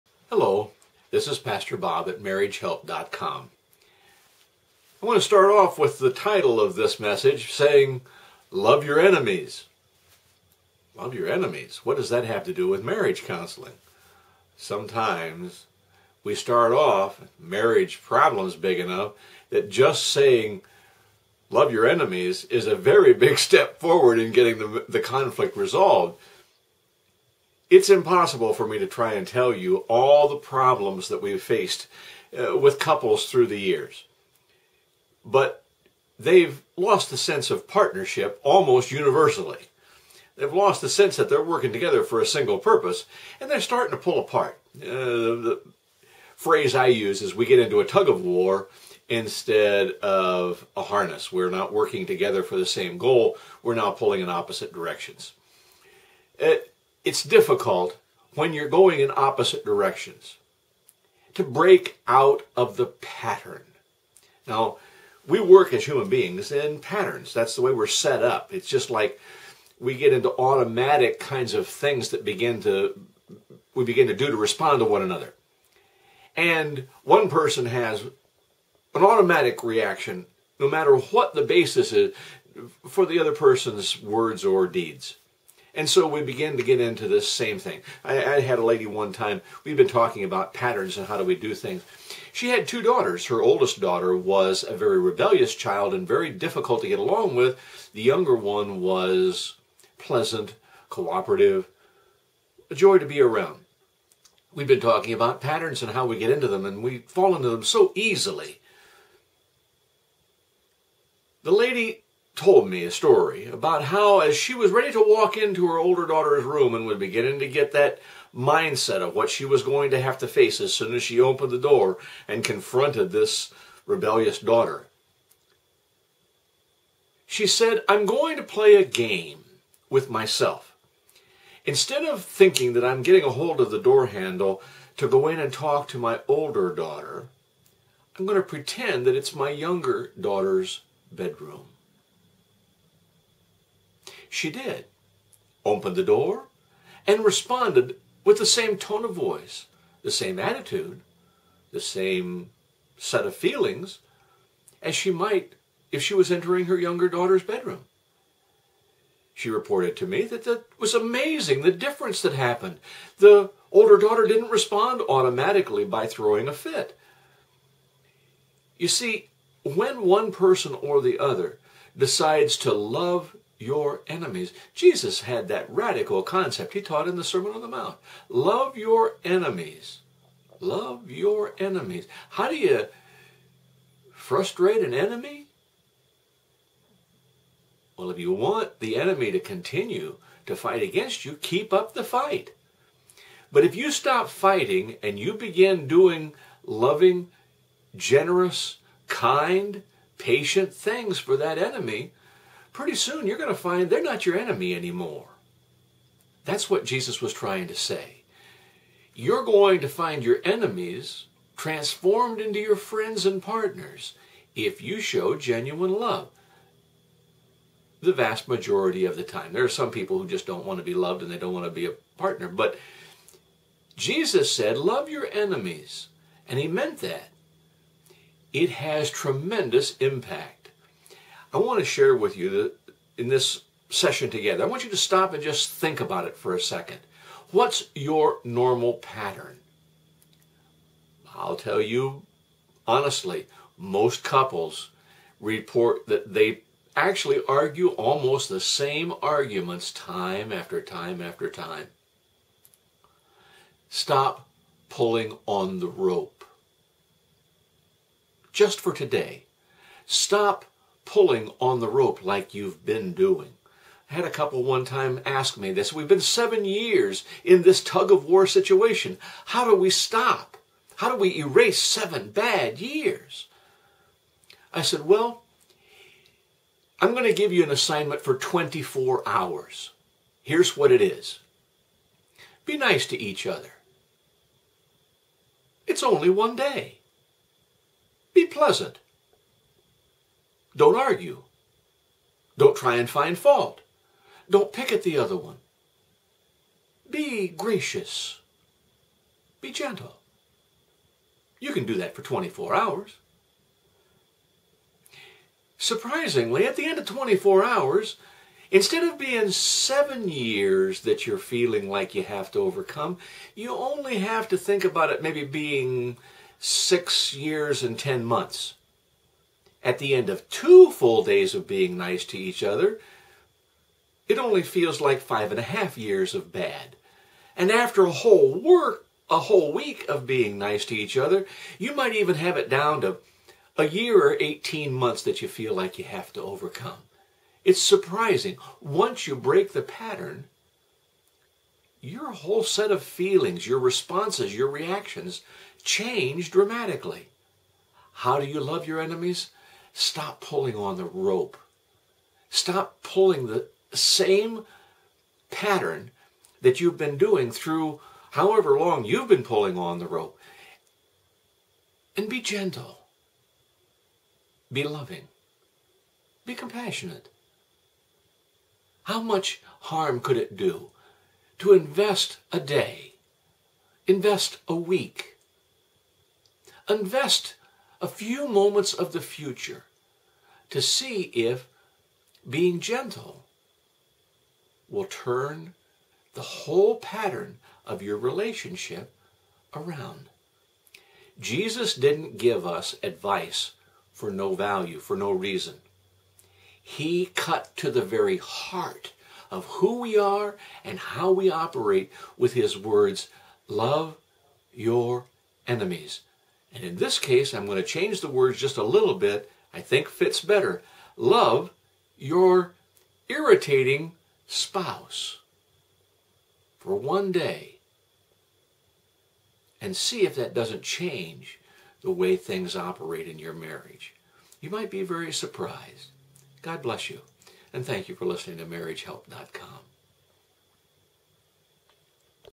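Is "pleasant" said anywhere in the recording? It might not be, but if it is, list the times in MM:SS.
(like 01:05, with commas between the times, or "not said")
01:39, 04:48.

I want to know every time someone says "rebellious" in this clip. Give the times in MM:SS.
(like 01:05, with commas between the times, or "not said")
01:34, 02:03.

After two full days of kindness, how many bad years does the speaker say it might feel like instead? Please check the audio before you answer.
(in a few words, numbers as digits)
5.5 years.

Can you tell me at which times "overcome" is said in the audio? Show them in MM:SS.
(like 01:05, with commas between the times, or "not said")
05:12, 05:36.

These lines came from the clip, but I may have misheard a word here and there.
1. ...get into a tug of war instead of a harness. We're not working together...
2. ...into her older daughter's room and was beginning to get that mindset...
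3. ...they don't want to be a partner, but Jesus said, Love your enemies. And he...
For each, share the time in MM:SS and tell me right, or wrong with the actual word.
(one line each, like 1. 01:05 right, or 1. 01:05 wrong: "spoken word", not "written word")
1. 00:47 right
2. 01:55 right
3. 03:41 right.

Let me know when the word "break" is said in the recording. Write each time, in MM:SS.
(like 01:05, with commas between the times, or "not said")
01:01, 05:39.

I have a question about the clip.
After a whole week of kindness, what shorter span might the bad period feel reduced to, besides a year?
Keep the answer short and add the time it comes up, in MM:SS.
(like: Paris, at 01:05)
18 months, at 05:34.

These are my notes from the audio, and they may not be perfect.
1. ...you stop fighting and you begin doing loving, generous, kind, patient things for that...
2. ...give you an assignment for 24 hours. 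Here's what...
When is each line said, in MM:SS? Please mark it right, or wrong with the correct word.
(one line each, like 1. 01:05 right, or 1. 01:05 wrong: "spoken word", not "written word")
1. 03:13 right
2. 04:37 right.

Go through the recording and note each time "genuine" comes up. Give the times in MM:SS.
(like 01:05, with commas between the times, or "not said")
03:35.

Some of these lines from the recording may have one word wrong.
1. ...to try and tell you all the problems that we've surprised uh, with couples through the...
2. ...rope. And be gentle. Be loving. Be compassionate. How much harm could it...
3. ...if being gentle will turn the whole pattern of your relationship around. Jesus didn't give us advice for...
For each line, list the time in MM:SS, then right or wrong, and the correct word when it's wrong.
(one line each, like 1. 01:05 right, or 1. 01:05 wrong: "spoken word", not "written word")
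1. 00:28 wrong: "faced", not "surprised"
2. 06:00 right
3. 06:21 right.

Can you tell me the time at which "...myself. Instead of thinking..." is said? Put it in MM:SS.
02:10.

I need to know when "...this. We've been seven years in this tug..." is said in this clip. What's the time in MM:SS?
04:25.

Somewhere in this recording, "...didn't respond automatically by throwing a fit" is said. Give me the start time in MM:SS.
02:44.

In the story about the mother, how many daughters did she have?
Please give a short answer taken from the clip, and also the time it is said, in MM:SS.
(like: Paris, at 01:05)
2, at 01:32.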